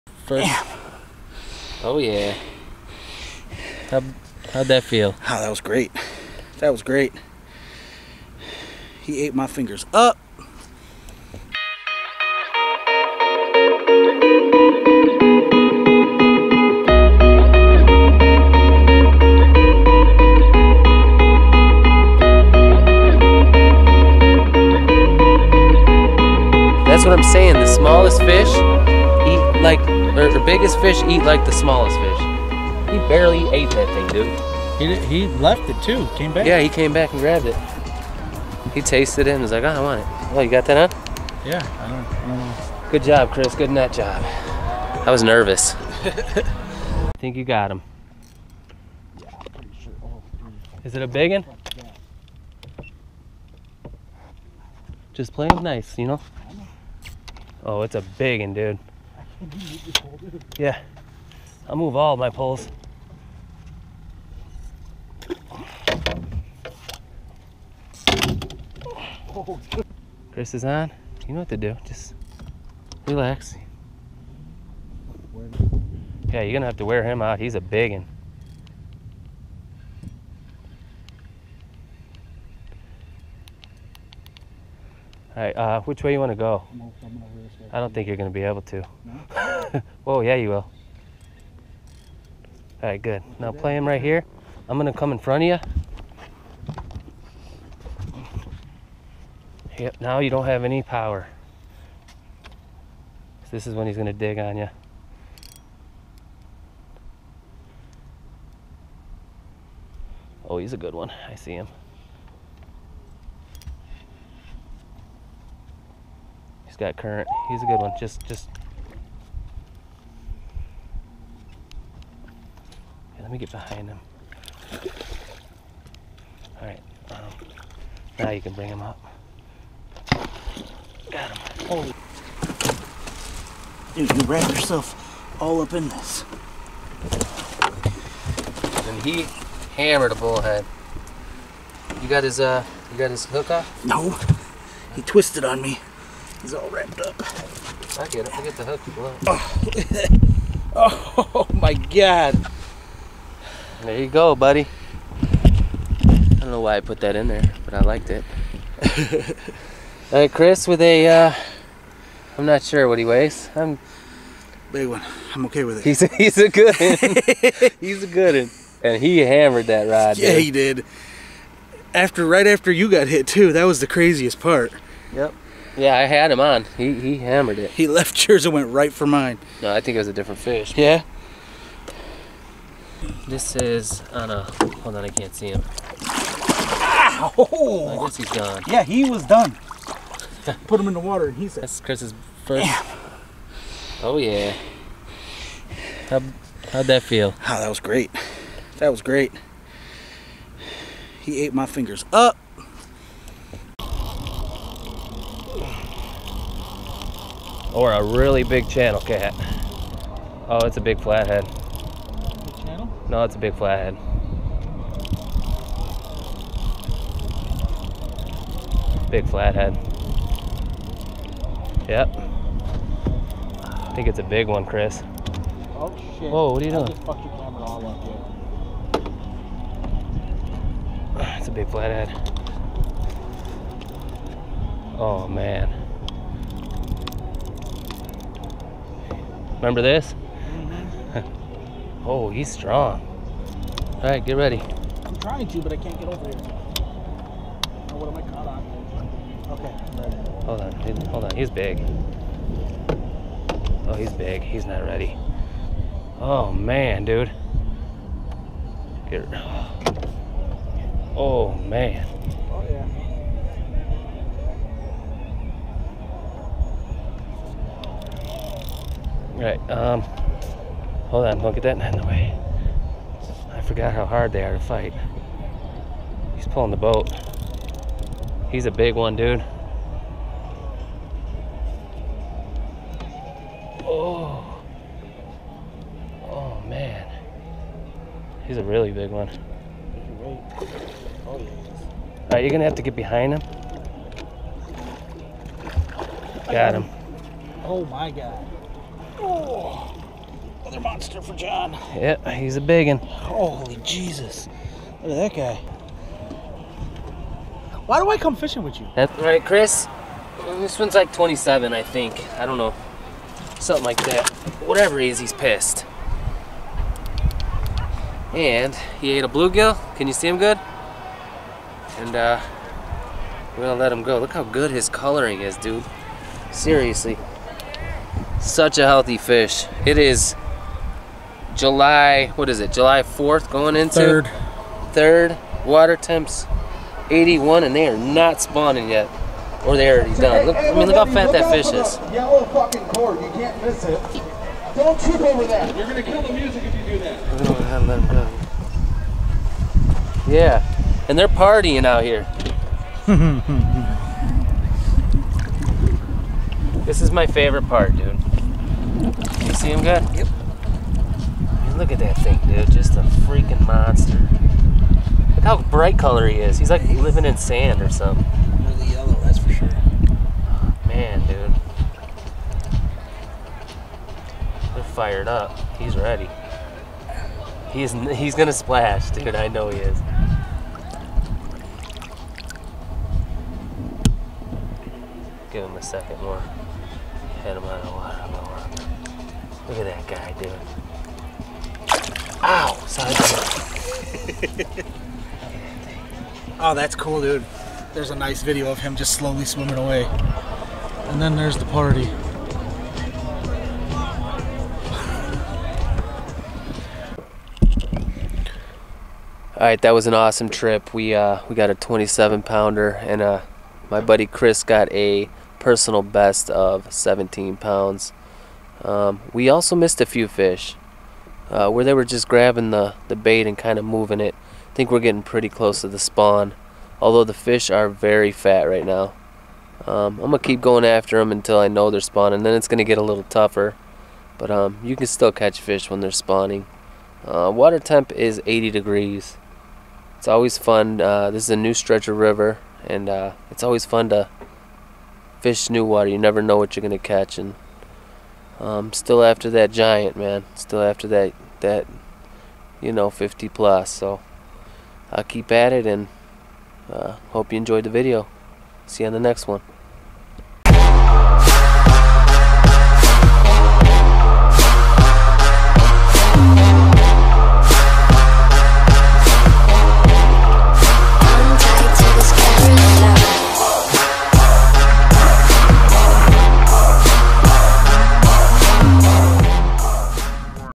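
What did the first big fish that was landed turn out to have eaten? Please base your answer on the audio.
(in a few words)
a bullhead.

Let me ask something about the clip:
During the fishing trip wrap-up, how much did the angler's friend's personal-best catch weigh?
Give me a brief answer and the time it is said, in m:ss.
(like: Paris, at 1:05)
17 pounds, at 6:56.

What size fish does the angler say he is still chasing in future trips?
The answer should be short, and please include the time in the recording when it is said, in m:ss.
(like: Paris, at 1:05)
50 plus, at 7:33.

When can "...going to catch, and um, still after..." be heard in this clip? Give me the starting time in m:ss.
7:26.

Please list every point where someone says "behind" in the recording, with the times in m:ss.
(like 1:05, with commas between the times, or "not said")
2:03, 4:52.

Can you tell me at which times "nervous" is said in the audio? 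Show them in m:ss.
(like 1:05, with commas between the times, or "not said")
0:45.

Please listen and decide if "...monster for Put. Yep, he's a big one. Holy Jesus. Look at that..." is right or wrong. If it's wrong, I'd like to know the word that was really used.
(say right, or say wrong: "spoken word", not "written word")
wrong: "John", not "Put".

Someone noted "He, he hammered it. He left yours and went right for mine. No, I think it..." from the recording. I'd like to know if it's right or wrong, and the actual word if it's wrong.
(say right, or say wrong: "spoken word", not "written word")
right.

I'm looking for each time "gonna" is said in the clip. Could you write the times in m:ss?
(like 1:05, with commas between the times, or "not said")
1:16, 4:52, 5:23, 5:45, 6:18.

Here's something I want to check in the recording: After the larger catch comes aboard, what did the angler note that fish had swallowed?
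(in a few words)
a bluegill.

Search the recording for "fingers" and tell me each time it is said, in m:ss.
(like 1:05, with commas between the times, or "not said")
0:09, 3:21.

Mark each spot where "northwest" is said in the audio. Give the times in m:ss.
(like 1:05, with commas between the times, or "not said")
not said.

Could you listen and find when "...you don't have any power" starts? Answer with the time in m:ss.
1:40.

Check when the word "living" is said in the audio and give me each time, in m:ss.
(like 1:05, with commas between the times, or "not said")
6:06.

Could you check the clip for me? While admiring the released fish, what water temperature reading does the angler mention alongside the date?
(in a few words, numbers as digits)
81.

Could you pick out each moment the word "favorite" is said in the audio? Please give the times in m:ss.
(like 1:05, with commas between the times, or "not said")
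5:57.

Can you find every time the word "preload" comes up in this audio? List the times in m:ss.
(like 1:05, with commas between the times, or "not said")
not said.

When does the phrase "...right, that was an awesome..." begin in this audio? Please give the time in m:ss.
6:49.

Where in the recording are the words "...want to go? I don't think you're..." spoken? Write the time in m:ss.
1:26.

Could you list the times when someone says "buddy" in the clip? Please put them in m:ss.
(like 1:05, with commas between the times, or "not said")
2:34, 6:54.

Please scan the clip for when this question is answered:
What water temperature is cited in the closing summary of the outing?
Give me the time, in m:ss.
7:18.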